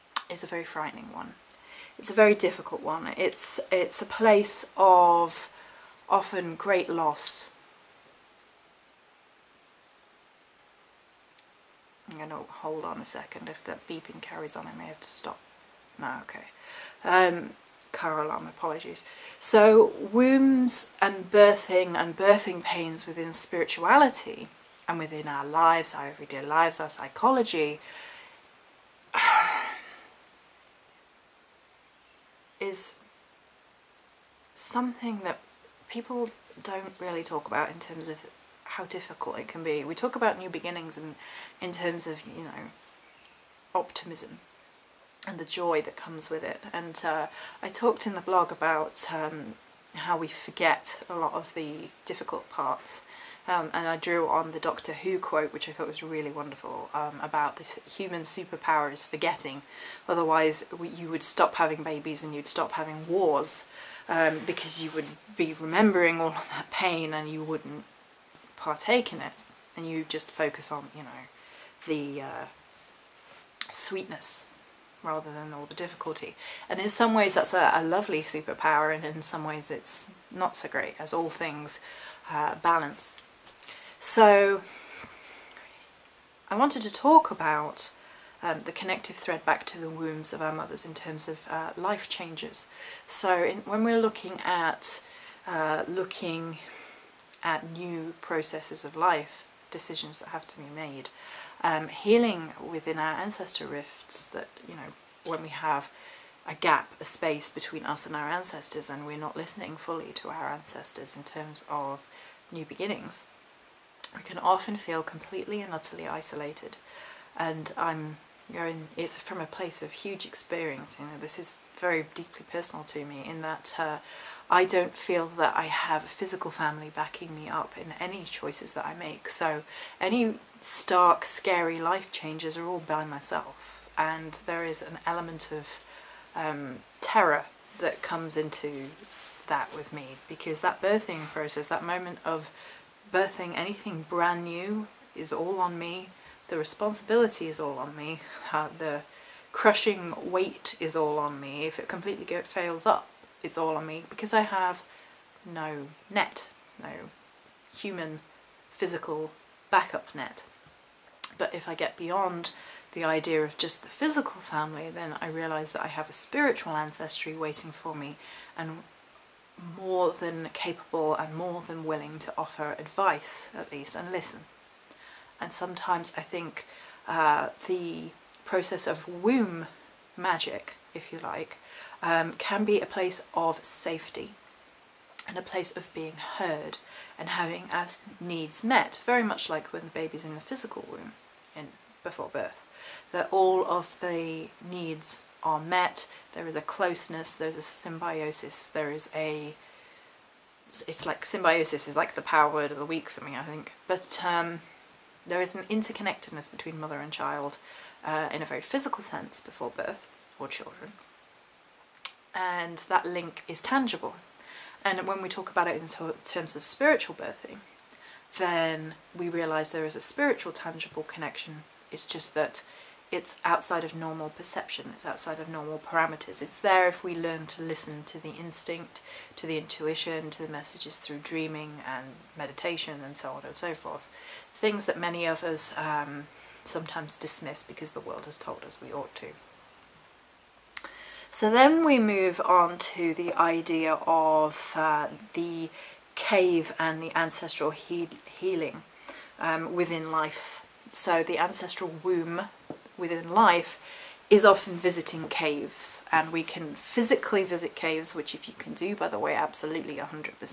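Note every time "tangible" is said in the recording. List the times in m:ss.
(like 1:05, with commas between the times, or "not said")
3:33, 3:40.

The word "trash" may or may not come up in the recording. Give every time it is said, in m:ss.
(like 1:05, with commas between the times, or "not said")
not said.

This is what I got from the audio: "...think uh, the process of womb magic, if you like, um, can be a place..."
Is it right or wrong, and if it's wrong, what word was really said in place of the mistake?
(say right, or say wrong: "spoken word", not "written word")
right.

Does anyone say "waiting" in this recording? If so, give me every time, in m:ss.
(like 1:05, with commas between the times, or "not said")
2:47.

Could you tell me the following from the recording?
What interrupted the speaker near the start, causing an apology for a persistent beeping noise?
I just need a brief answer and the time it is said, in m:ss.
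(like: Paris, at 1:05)
Car alarm, at 0:17.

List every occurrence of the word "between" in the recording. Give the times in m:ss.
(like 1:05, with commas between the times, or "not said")
1:47, 3:26.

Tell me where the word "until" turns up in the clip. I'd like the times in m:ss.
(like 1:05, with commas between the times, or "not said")
not said.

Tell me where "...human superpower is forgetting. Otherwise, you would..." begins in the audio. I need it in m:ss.
0:57.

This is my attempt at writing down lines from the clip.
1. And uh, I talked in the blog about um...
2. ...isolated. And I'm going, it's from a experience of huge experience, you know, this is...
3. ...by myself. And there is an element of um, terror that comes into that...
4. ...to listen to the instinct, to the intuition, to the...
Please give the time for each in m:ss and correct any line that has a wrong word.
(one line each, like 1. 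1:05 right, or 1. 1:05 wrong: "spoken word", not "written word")
1. 0:46 right
2. 1:56 wrong: "place", not "experience"
3. 2:12 right
4. 3:47 right.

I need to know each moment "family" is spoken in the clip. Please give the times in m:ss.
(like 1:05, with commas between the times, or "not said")
2:06, 2:44.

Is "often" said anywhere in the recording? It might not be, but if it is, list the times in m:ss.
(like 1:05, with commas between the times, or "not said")
0:06, 1:54, 4:14.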